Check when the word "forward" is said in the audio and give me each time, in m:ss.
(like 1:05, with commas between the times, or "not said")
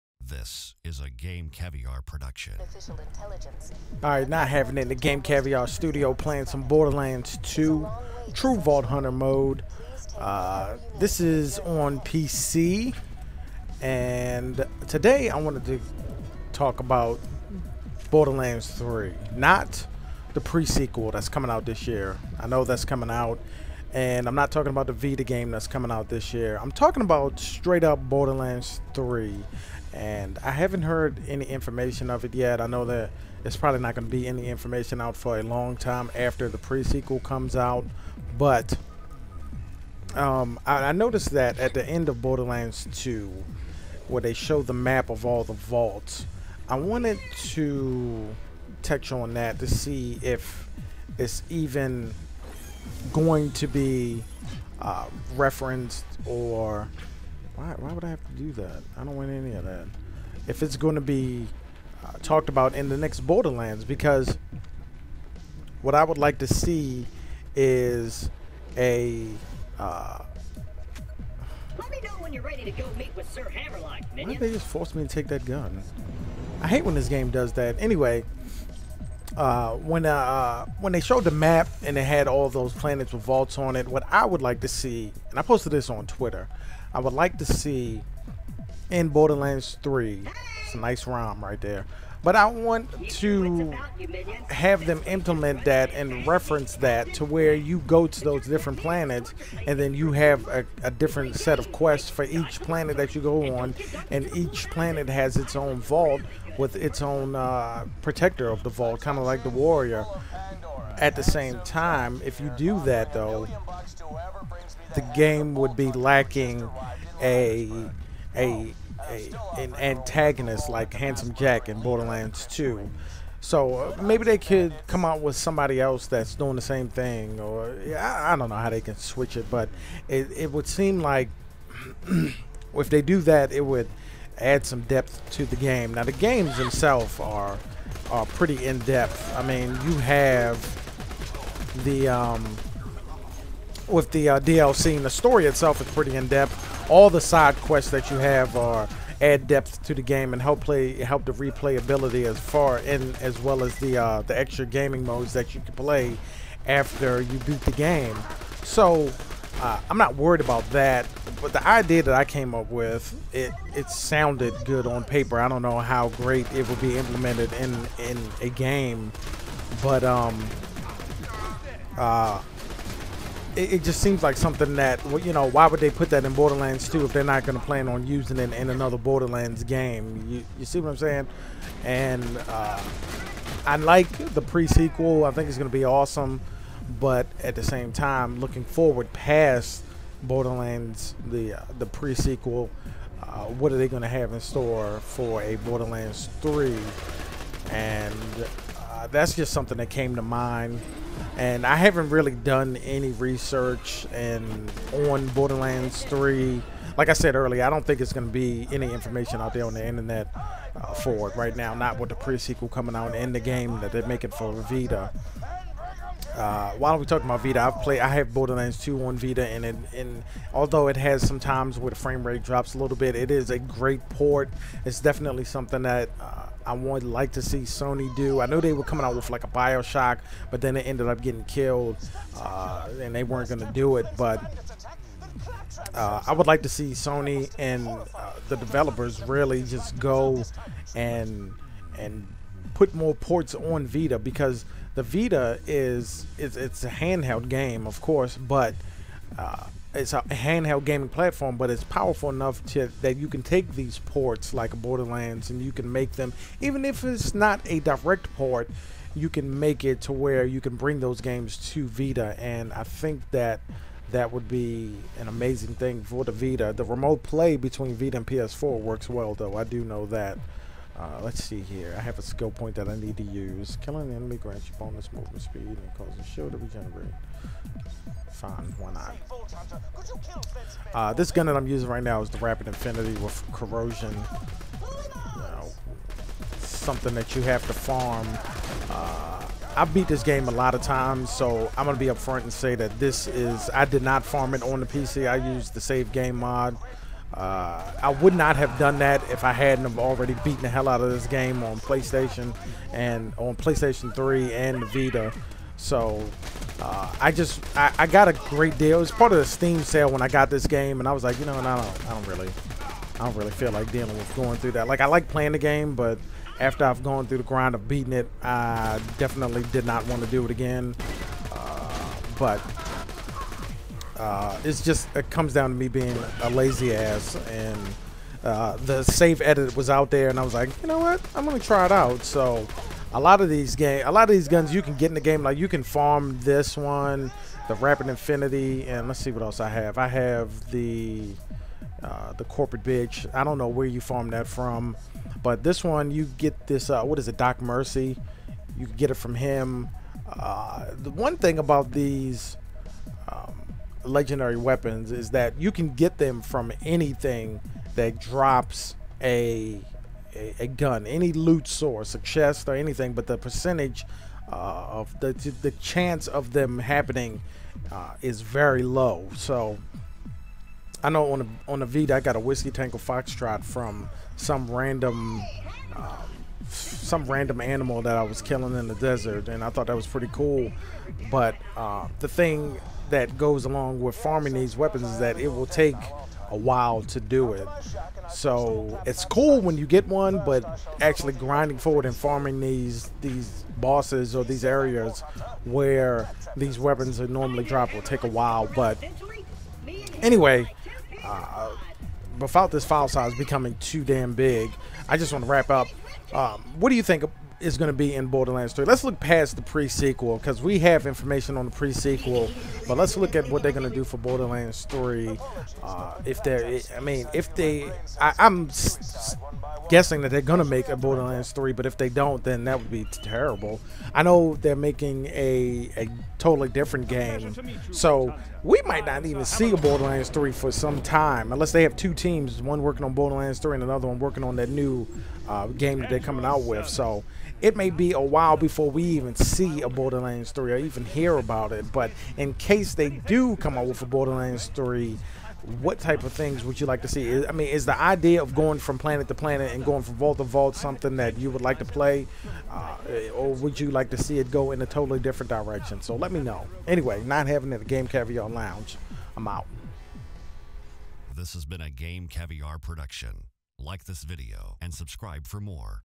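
3:08, 6:31.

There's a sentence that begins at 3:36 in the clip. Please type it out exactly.
Uh, while we talking about Vita, I've played.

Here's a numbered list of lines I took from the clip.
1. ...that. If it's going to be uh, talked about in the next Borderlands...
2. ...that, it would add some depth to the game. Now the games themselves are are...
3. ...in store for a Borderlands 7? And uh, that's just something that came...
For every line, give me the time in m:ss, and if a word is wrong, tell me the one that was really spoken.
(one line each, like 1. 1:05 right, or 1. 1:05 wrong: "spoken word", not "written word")
1. 0:59 right
2. 2:13 right
3. 3:14 wrong: "3", not "7".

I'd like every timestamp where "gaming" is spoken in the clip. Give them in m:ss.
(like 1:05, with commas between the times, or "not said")
2:34, 4:10.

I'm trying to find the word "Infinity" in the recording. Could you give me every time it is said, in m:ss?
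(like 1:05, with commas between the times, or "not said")
4:42, 5:38.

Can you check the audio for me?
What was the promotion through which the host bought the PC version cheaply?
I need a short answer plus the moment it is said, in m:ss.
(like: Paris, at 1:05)
Steam sale, at 5:09.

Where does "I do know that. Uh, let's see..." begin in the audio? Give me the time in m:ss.
4:29.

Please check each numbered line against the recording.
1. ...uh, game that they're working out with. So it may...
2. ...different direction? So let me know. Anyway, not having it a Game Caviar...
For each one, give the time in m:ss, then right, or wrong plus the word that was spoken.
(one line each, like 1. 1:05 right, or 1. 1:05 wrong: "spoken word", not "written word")
1. 7:15 wrong: "coming", not "working"
2. 7:35 right.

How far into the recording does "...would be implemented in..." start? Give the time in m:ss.
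2:46.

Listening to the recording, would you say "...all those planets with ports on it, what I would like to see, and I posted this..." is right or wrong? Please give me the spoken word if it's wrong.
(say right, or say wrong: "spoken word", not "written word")
wrong: "vaults", not "ports".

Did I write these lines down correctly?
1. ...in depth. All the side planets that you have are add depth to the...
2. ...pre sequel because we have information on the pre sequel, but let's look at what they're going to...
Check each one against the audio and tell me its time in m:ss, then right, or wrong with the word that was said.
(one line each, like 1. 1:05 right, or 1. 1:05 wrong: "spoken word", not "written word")
1. 2:26 wrong: "quests", not "planets"
2. 6:49 right.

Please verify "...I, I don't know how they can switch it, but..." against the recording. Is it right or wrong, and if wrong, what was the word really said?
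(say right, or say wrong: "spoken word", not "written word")
right.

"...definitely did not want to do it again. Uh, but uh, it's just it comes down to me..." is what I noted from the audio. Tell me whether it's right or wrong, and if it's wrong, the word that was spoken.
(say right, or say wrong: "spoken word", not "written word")
right.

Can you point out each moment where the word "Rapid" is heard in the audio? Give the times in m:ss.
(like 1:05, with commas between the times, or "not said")
4:42, 5:37.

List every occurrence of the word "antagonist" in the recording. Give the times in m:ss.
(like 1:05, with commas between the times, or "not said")
1:59.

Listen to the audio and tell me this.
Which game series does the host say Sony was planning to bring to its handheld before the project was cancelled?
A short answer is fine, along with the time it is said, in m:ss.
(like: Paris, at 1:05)
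Bioshock, at 3:49.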